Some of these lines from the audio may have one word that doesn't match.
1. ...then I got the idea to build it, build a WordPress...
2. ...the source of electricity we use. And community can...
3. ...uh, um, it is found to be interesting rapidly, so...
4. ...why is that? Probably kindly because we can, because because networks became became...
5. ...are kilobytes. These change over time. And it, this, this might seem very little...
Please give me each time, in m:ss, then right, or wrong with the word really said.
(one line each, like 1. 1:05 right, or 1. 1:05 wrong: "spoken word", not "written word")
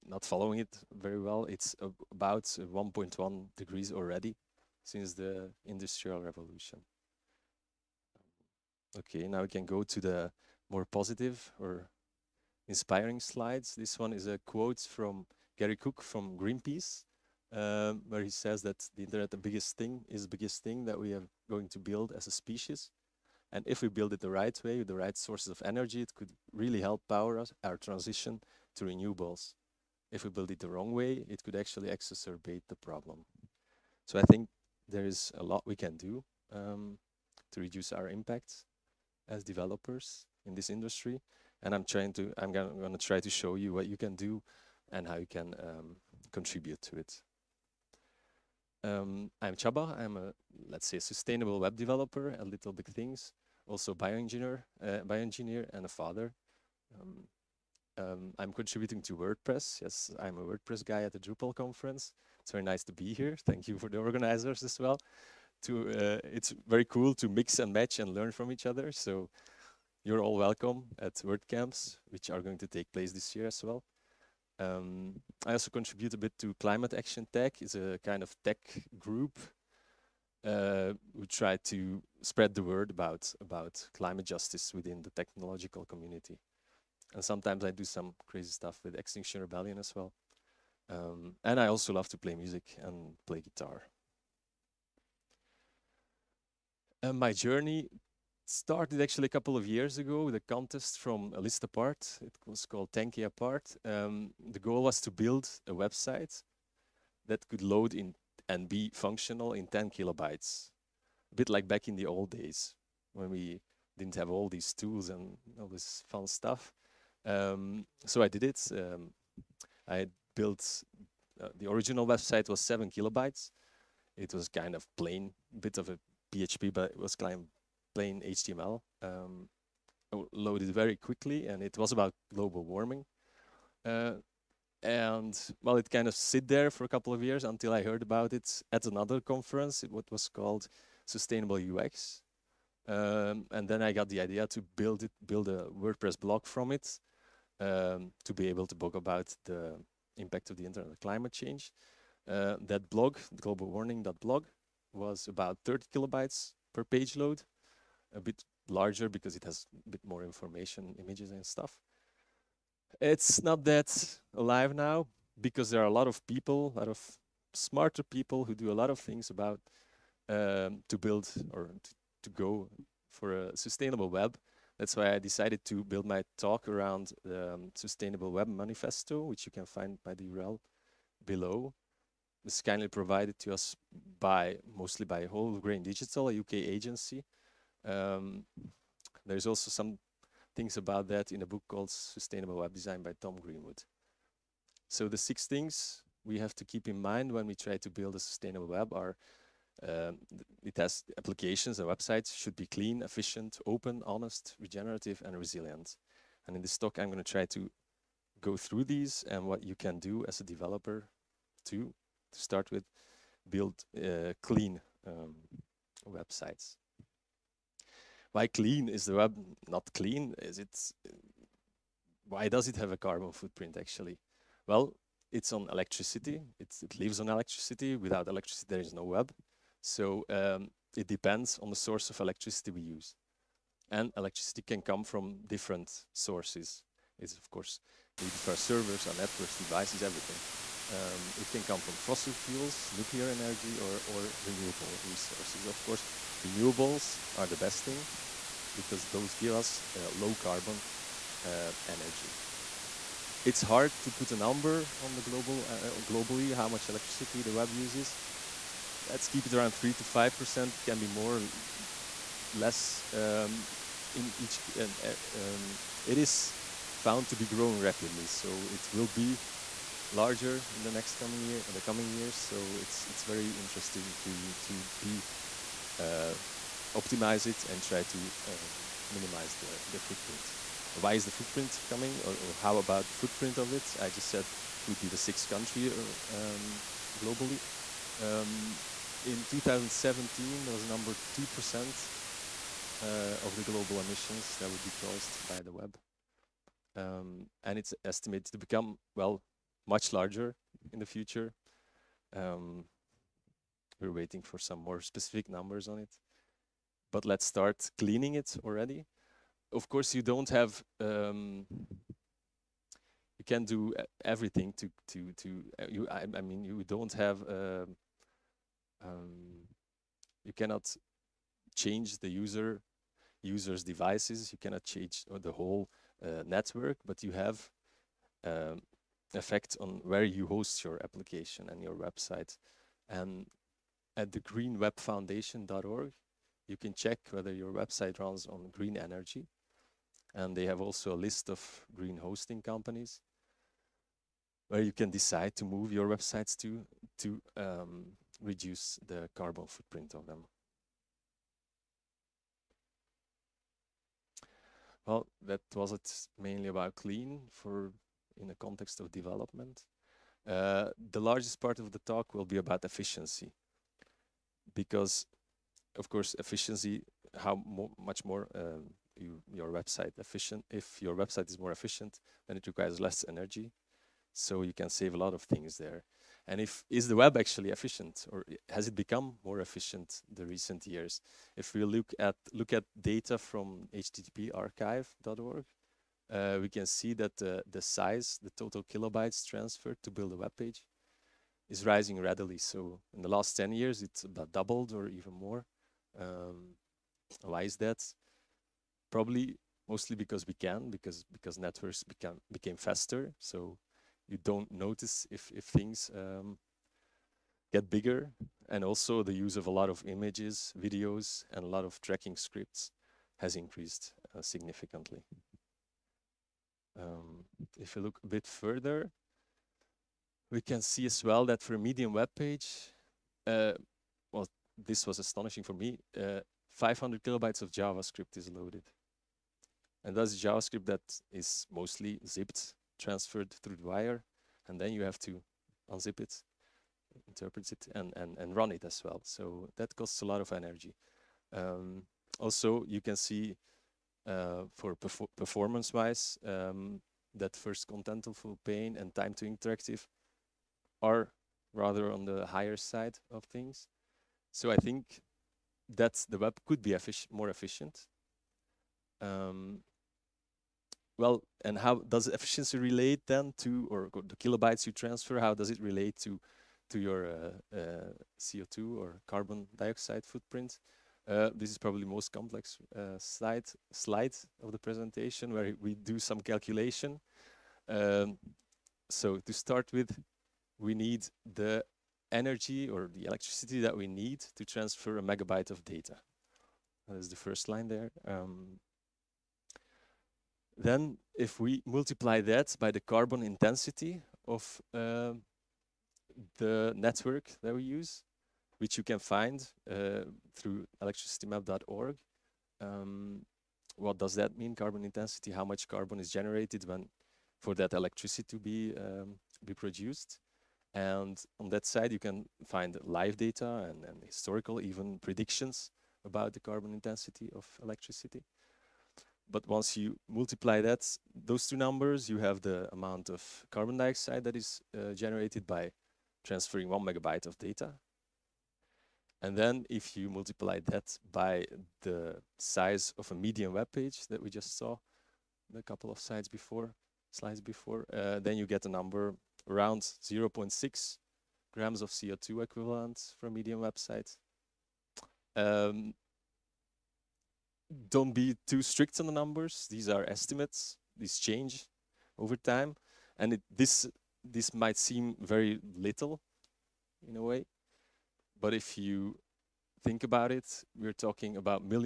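1. 2:23 right
2. 3:51 wrong: "electricity", not "community"
3. 4:25 wrong: "growing", not "interesting"
4. 6:37 wrong: "mostly", not "kindly"
5. 9:10 wrong: "estimates", not "kilobytes".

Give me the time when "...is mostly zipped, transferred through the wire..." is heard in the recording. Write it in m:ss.
7:11.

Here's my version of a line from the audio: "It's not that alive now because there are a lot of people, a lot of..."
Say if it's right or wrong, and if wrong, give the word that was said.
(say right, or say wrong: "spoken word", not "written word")
right.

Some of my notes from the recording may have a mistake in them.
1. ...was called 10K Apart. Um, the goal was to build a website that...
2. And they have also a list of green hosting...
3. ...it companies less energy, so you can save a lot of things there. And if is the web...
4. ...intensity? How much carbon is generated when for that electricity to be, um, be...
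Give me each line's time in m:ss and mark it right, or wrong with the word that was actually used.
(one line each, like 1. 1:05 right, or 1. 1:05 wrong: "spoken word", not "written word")
1. 1:42 right
2. 5:40 right
3. 6:12 wrong: "requires", not "companies"
4. 8:25 right.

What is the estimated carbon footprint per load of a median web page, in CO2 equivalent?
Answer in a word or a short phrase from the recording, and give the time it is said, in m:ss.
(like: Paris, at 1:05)
0.6 grams, at 9:00.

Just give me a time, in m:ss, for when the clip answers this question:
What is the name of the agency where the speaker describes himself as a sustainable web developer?
0:52.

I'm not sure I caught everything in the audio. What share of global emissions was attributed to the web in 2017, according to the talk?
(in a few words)
2%.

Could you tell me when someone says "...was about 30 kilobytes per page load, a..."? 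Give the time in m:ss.
2:34.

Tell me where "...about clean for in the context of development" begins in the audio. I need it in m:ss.
5:56.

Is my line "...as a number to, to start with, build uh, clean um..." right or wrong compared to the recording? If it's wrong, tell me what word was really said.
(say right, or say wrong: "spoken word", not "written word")
wrong: "developer", not "number".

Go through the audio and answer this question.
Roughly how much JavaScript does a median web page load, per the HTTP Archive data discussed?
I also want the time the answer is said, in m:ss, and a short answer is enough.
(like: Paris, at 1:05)
500 kilobytes, at 7:06.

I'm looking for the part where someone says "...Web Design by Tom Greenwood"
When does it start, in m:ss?
3:12.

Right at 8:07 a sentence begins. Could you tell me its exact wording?
That is the first line there.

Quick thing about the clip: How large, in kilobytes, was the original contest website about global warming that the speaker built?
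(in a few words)
7 kilobytes.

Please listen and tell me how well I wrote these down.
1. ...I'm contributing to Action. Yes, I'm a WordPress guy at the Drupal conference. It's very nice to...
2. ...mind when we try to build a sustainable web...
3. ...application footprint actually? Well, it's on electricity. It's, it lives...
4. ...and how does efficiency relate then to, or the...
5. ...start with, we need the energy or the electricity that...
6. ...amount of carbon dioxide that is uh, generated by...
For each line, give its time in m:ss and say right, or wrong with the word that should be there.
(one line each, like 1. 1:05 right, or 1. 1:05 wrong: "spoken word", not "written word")
1. 0:58 wrong: "WordPress", not "Action"
2. 3:17 right
3. 3:42 wrong: "carbon", not "application"
4. 7:41 right
5. 7:59 right
6. 8:42 right.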